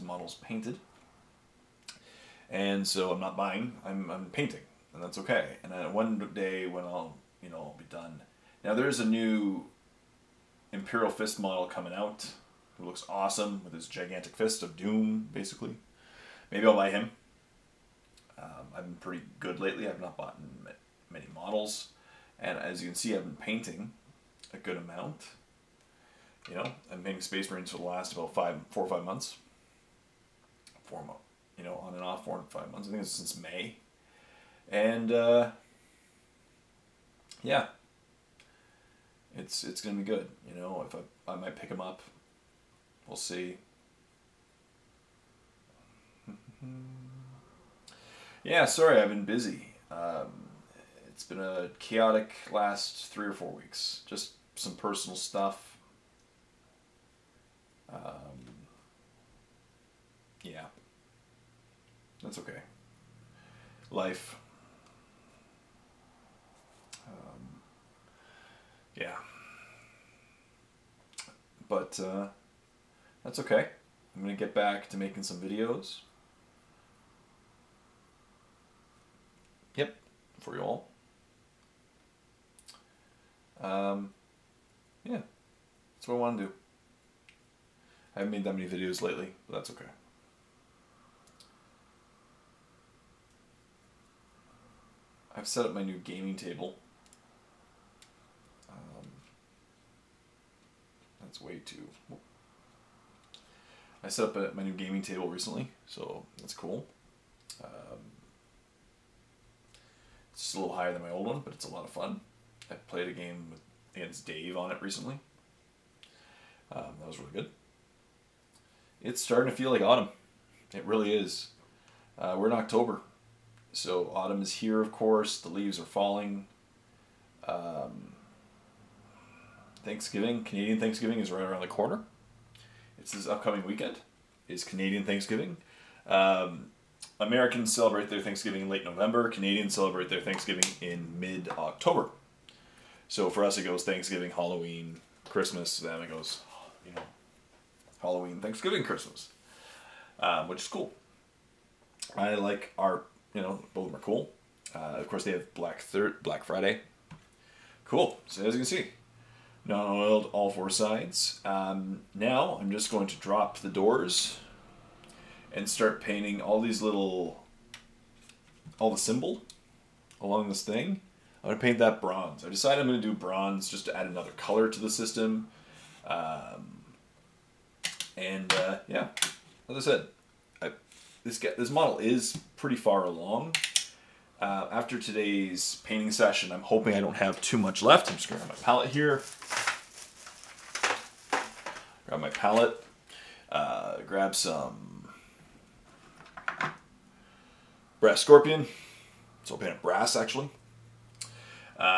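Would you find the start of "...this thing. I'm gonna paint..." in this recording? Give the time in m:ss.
2:50.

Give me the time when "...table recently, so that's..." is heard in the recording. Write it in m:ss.
1:45.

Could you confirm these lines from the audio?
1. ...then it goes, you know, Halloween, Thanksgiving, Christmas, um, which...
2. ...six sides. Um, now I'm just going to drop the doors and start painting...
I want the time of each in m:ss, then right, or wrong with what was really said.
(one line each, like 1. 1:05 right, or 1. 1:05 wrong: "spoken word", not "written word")
1. 2:25 right
2. 2:40 wrong: "four", not "six".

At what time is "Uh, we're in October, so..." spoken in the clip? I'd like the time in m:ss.
2:02.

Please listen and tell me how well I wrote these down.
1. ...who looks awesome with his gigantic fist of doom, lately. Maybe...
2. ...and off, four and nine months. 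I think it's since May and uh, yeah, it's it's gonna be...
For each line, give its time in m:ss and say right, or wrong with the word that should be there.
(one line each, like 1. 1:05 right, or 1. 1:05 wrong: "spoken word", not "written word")
1. 0:12 wrong: "basically", not "lately"
2. 0:31 wrong: "five", not "nine".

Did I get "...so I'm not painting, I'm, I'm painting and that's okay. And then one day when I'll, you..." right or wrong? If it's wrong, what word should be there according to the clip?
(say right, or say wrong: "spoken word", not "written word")
wrong: "buying", not "painting".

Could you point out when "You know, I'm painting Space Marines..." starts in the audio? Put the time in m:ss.
0:26.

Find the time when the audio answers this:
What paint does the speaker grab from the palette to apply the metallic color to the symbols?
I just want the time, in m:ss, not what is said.
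3:18.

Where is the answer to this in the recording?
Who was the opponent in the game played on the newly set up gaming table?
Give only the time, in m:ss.
1:54.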